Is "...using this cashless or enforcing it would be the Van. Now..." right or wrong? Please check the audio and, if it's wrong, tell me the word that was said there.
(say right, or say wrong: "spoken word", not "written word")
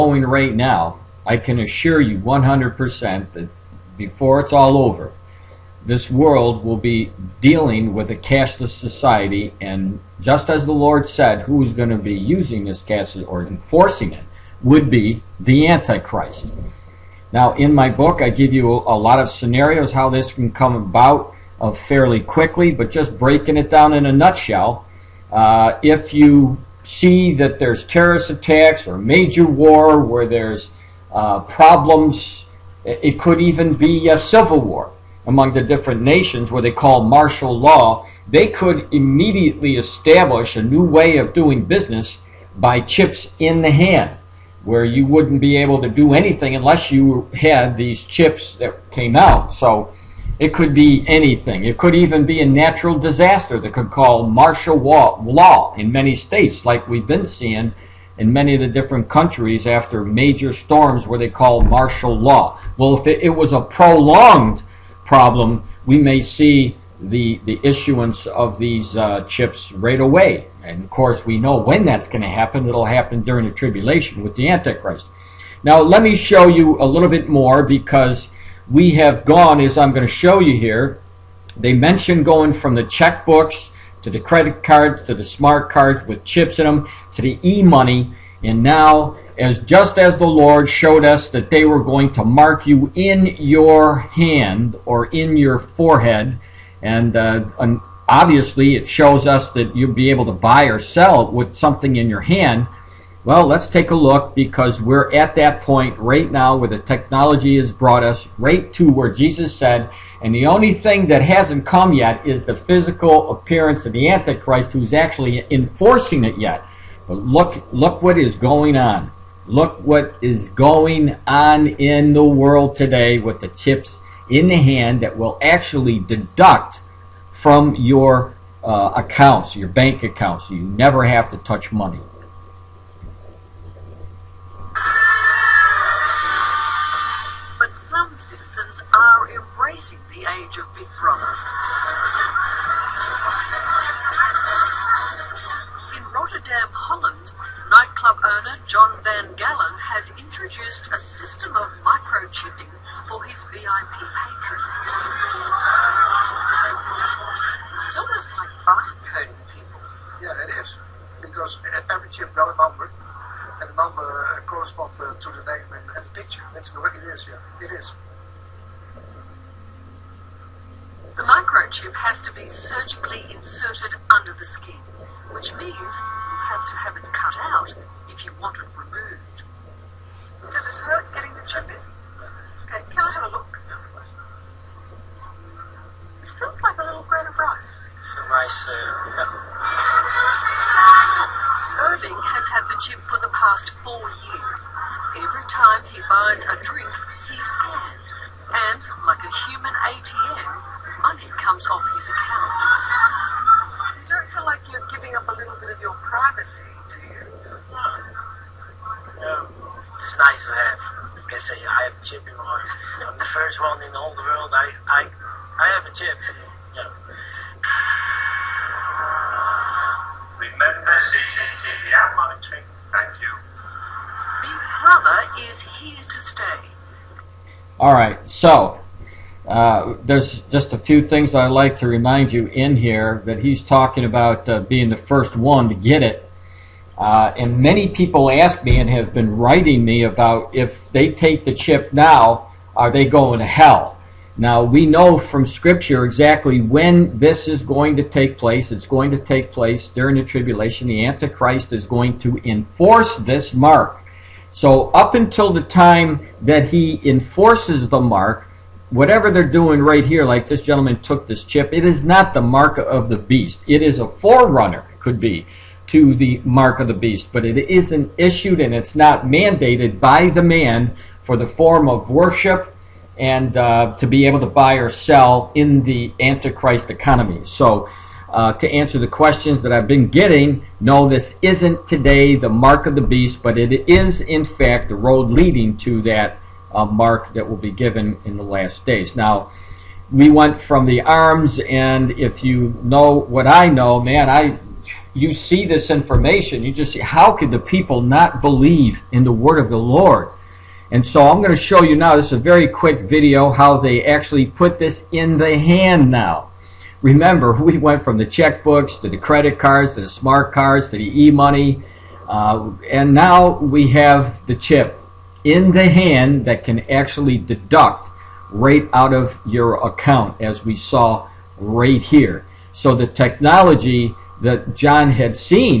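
wrong: "Antichrist", not "Van".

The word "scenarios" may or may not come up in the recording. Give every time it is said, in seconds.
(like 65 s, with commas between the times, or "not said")
19 s.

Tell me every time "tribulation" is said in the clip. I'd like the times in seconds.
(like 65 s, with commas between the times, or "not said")
73 s, 250 s.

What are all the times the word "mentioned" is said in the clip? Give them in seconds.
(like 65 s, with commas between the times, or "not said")
81 s.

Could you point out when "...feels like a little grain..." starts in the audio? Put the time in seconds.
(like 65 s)
186 s.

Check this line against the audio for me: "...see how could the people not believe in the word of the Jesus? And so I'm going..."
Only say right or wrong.
wrong.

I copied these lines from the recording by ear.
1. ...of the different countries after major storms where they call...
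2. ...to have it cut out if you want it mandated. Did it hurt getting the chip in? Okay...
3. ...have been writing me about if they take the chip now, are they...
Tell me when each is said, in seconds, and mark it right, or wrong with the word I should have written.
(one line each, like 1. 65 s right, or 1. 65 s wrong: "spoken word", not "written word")
1. 58 s right
2. 176 s wrong: "removed", not "mandated"
3. 238 s right.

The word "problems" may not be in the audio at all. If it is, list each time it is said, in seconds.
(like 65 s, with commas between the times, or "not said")
31 s, 65 s.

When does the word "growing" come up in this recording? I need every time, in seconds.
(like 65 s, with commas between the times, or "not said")
not said.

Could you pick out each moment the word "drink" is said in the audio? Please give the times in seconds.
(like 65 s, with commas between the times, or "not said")
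196 s.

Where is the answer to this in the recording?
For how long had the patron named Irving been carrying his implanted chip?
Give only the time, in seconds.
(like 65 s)
193 s.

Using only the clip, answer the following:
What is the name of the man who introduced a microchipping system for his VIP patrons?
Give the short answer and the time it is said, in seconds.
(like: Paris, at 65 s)
John Van Gallen, at 148 s.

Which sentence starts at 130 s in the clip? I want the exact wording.
You never have to touch money.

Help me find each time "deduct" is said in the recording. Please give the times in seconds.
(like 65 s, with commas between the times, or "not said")
125 s, 317 s.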